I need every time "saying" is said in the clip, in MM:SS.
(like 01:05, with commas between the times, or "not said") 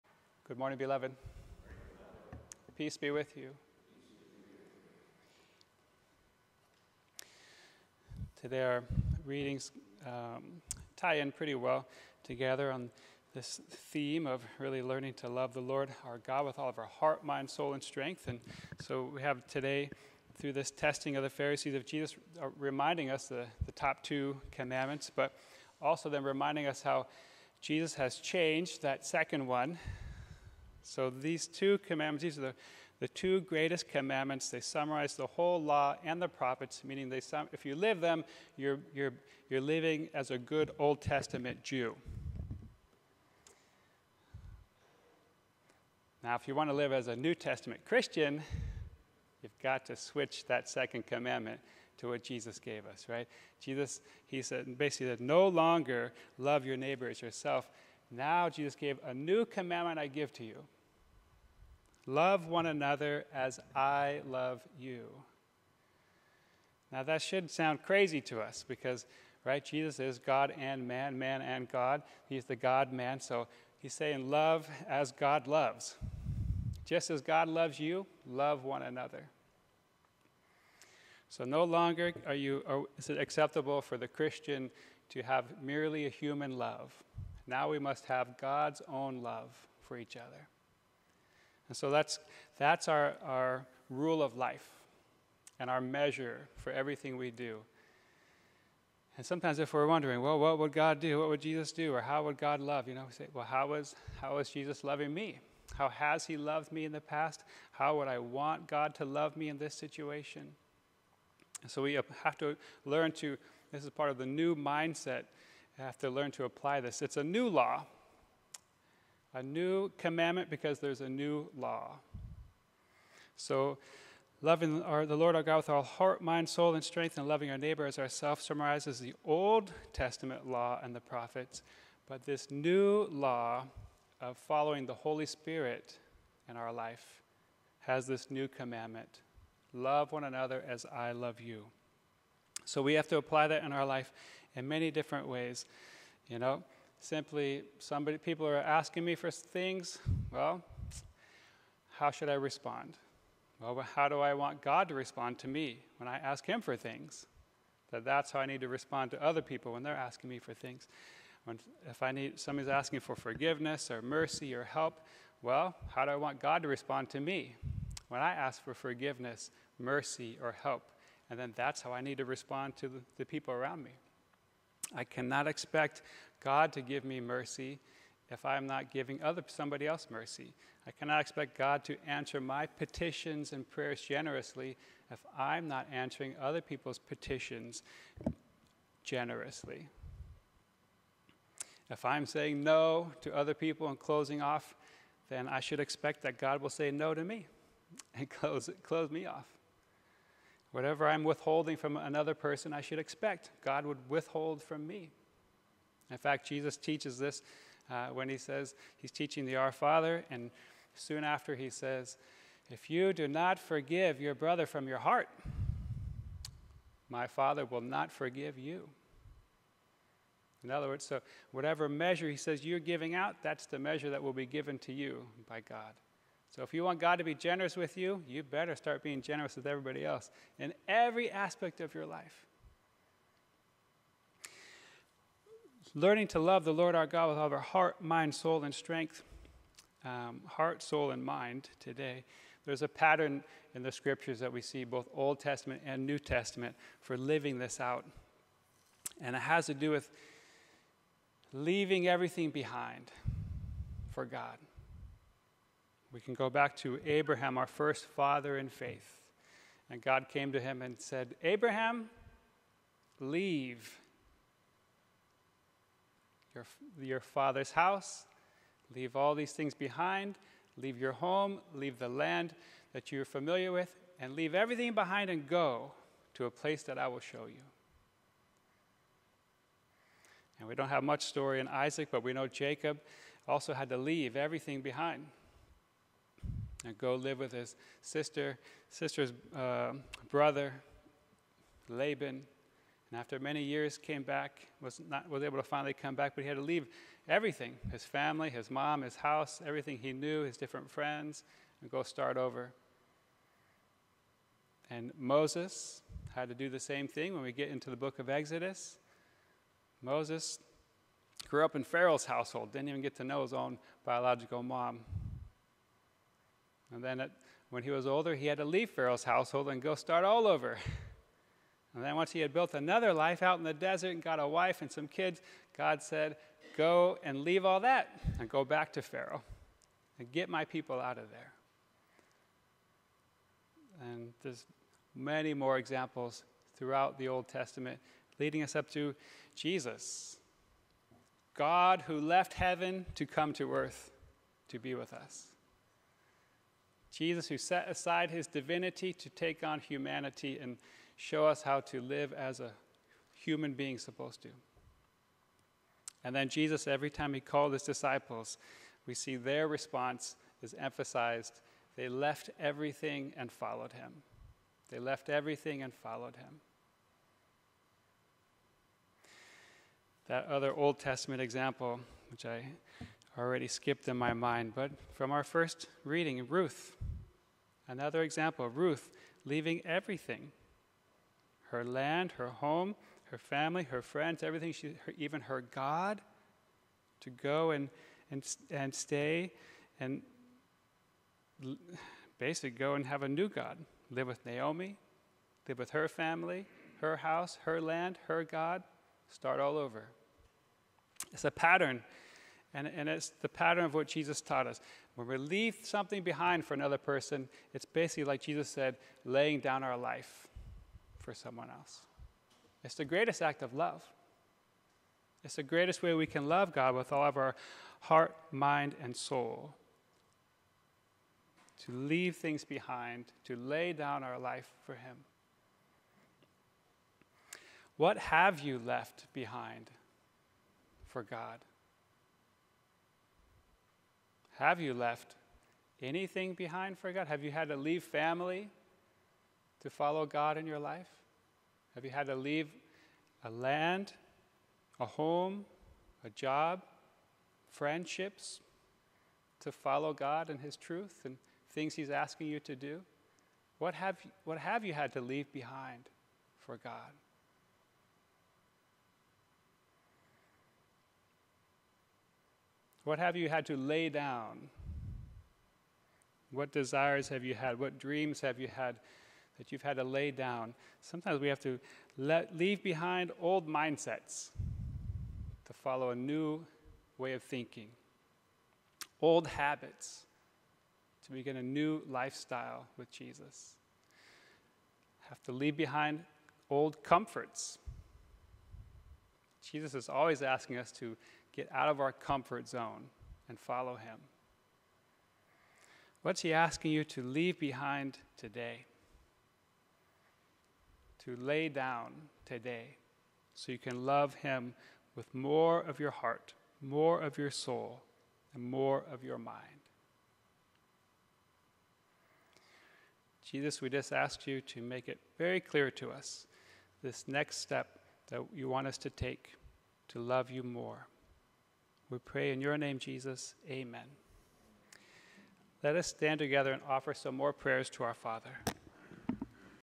01:13, 03:12.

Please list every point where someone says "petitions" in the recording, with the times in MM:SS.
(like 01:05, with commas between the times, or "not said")
03:02, 03:06.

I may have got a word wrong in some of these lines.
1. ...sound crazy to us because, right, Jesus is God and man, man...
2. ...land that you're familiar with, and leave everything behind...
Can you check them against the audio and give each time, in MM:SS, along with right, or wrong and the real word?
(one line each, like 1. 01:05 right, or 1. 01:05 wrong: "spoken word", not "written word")
1. 01:07 right
2. 04:32 right.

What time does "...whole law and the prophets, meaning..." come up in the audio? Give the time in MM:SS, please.
00:35.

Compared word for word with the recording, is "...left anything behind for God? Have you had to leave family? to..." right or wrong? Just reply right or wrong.
right.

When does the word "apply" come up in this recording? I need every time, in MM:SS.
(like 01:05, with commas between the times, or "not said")
01:56, 02:23.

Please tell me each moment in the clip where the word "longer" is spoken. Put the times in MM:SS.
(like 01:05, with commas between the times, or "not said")
00:55, 01:21.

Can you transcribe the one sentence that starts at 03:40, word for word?
In other words, so whatever measure he says you're giving out, that's the measure that will be given to you by God.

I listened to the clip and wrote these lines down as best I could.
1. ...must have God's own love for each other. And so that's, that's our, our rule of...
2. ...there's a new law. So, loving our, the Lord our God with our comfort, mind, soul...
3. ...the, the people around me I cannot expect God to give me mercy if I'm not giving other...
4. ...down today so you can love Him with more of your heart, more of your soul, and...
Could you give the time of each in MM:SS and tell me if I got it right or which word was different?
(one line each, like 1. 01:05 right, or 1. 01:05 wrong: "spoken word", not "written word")
1. 01:27 right
2. 02:00 wrong: "heart", not "comfort"
3. 02:52 right
4. 08:21 right.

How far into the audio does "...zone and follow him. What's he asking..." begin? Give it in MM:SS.
08:12.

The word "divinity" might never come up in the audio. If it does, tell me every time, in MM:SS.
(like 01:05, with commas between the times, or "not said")
05:48.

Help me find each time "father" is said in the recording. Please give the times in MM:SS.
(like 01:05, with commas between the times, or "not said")
03:29, 03:37, 04:18, 04:27, 08:48.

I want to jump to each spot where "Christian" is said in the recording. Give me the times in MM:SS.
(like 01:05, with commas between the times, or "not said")
00:47, 01:24.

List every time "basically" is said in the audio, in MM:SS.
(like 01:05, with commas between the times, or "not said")
00:54, 06:32, 06:47.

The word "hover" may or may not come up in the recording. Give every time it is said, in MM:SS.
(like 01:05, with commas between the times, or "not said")
not said.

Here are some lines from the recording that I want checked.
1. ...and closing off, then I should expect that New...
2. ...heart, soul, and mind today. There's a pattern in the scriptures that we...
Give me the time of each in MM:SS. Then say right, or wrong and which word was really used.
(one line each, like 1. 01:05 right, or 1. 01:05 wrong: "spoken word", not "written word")
1. 03:13 wrong: "God", not "New"
2. 04:00 right.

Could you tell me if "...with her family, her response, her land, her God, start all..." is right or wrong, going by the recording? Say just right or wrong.
wrong.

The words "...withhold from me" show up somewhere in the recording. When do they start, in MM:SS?
03:24.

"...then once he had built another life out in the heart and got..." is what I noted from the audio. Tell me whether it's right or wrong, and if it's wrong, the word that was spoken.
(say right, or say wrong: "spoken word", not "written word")
wrong: "desert", not "heart".